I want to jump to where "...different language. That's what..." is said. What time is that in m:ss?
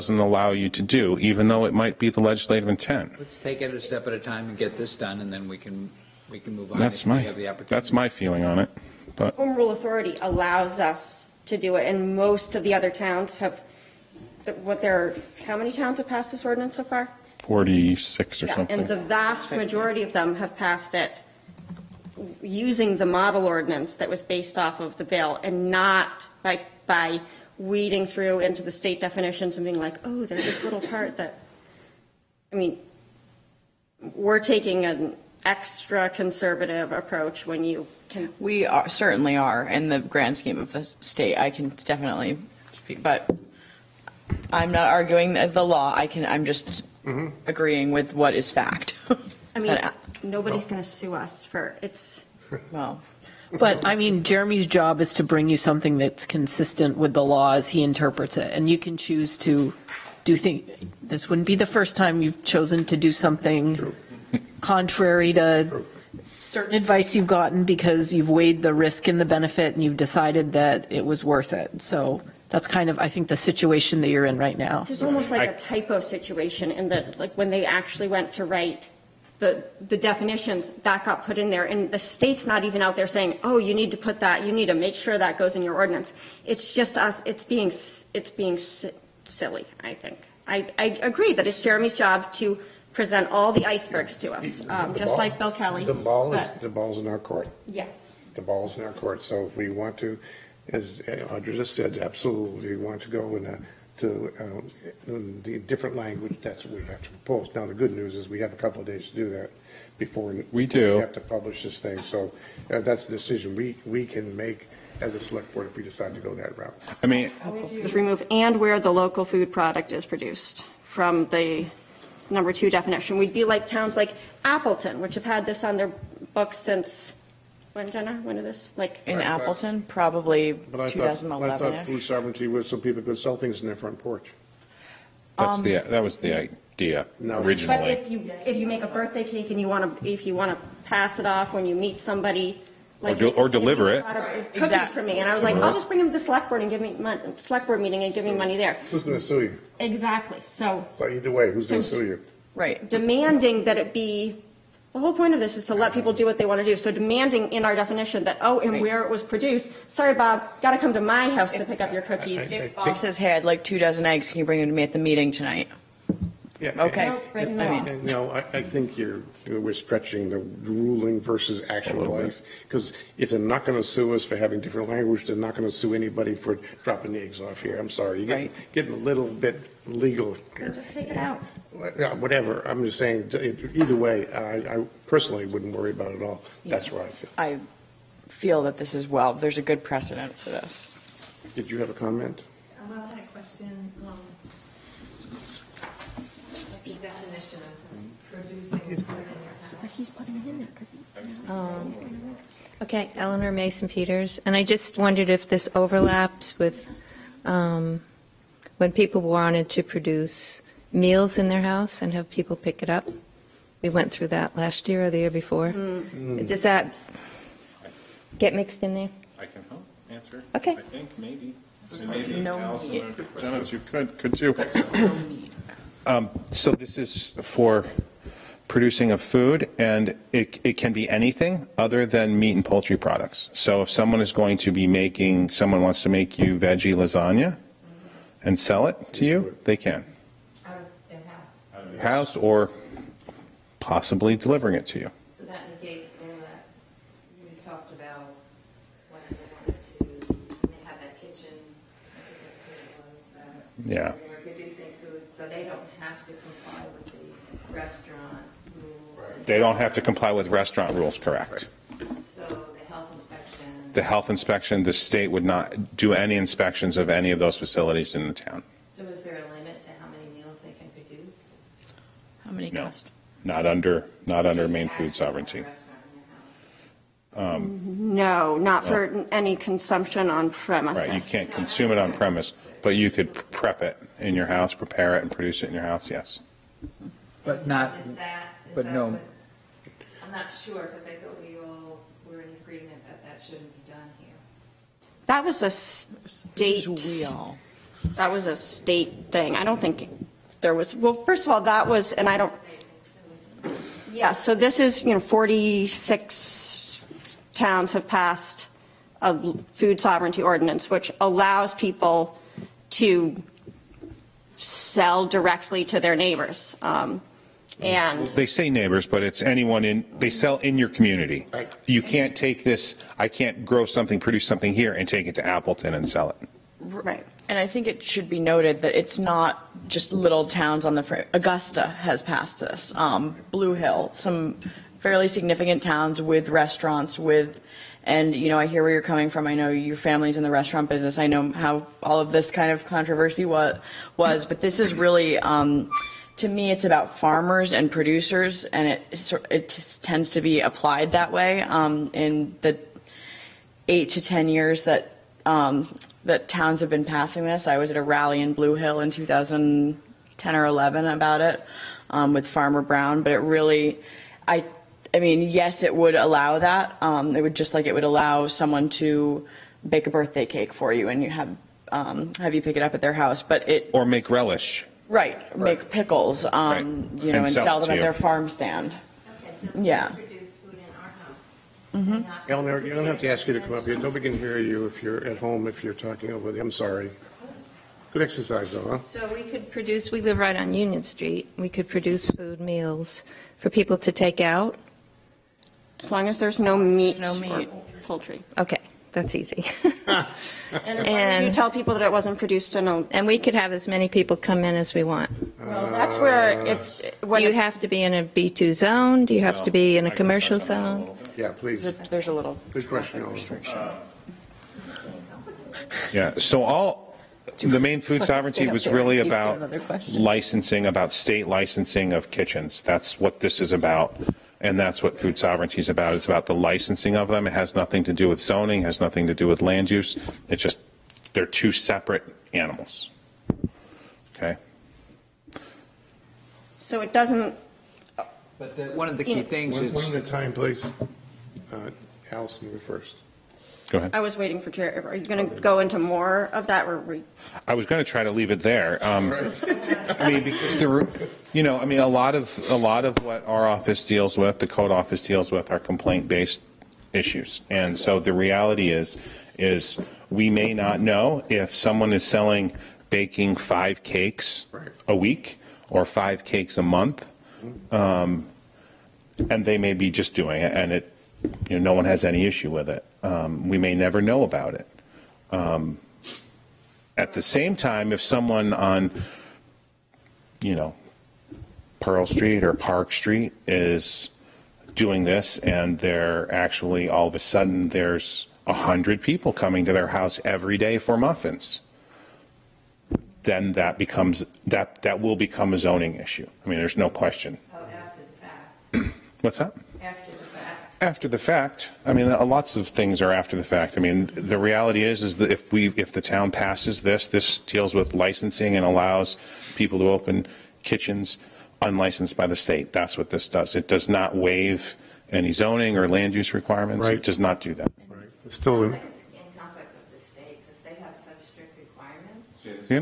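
1:45.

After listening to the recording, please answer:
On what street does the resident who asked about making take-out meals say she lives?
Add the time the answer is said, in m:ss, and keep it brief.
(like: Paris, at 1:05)
Union Street, at 6:30.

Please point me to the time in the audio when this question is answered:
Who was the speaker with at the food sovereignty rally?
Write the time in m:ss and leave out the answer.
6:02.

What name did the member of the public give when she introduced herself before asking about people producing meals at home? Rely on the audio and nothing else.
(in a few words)
Eleanor Mason Peters.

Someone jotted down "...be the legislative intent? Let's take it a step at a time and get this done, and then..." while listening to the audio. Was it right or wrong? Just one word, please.
right.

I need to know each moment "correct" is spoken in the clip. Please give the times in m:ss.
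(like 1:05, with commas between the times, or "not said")
4:21.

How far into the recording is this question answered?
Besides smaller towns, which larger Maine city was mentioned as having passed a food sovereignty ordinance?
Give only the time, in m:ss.
5:31.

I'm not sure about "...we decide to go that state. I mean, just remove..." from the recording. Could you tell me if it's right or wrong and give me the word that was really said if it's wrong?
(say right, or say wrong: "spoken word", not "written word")
wrong: "route", not "state".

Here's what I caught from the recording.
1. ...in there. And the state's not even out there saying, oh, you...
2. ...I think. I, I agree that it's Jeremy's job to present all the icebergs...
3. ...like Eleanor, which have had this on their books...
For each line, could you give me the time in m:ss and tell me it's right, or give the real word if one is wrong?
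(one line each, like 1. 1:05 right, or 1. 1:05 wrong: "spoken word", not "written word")
1. 1:21 right
2. 1:29 right
3. 2:03 wrong: "Appleton", not "Eleanor".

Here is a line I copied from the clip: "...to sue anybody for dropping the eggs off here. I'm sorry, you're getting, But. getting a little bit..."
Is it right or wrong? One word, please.
wrong.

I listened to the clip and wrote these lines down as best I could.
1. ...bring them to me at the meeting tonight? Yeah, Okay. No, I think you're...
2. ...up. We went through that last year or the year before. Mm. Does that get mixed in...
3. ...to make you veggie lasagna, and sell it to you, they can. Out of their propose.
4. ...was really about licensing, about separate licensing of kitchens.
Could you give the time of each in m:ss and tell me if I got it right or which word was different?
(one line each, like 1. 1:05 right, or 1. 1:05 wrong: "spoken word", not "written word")
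1. 2:44 right
2. 3:32 right
3. 3:56 wrong: "house", not "propose"
4. 6:58 wrong: "state", not "separate".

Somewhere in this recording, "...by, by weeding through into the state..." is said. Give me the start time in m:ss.
0:26.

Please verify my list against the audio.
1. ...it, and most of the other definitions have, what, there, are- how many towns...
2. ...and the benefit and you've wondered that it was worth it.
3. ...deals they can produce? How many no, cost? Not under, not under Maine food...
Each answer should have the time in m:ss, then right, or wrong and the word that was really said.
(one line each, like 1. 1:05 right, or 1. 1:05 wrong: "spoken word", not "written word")
1. 0:11 wrong: "towns", not "definitions"
2. 1:09 wrong: "decided", not "wondered"
3. 4:30 wrong: "meals", not "deals".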